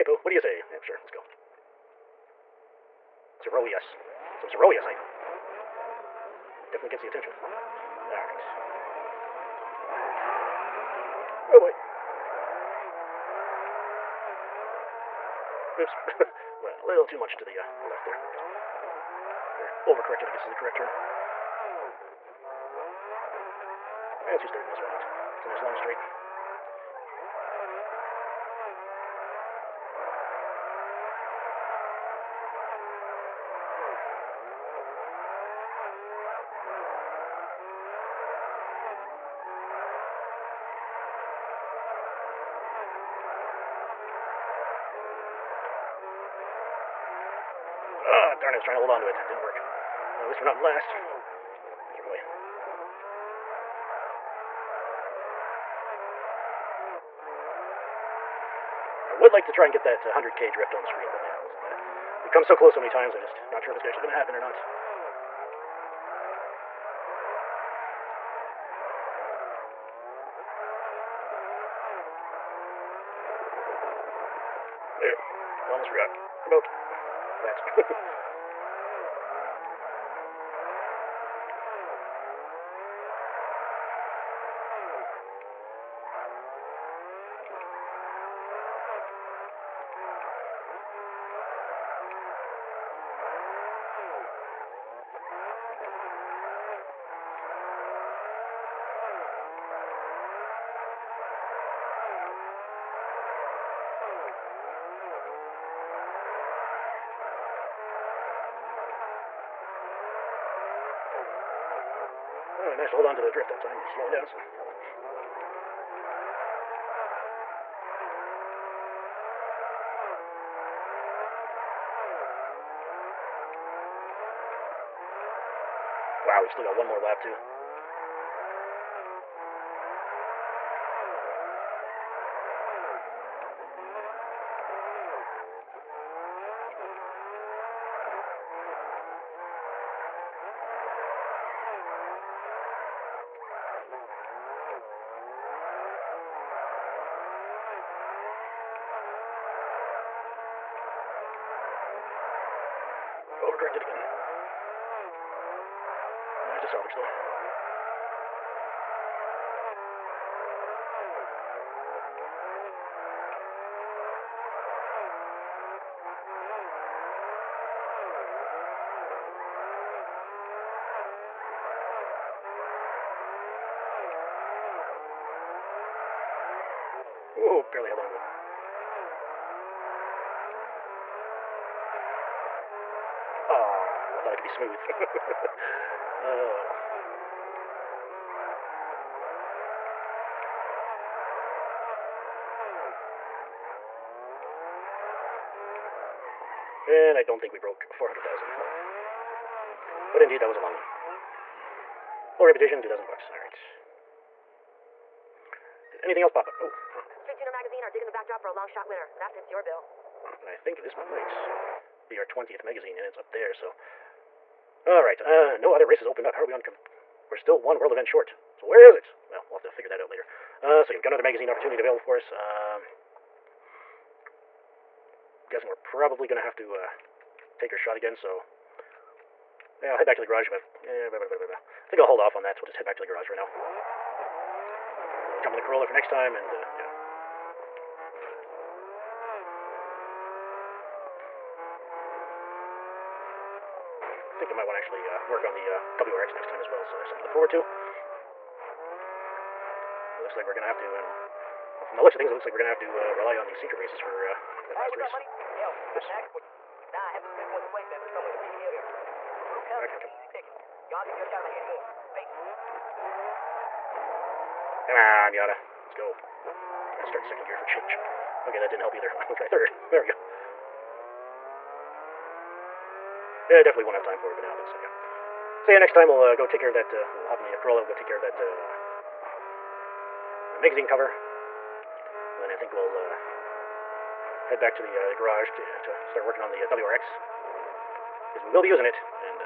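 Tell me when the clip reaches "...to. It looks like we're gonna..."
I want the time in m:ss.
4:07.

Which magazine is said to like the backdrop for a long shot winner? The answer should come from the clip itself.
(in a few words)
Street Tuner.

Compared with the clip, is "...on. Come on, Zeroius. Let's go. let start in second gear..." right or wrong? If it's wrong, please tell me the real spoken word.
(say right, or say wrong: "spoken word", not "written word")
wrong: "Miata", not "Zeroius".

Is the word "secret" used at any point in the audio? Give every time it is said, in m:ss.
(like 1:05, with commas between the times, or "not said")
4:13.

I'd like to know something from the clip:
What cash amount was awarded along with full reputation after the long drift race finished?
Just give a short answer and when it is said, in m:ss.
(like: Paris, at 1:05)
2,000 bucks, at 3:22.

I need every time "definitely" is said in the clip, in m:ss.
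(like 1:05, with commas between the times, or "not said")
0:06, 4:33.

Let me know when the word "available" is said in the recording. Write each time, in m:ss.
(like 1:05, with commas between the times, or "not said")
3:41.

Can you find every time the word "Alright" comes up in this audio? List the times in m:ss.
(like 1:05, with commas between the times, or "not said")
0:08, 3:23, 3:34.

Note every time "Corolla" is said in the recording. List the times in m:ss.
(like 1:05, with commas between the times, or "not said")
3:55, 4:37.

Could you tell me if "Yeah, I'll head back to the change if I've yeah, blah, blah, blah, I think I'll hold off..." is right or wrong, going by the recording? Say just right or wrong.
wrong.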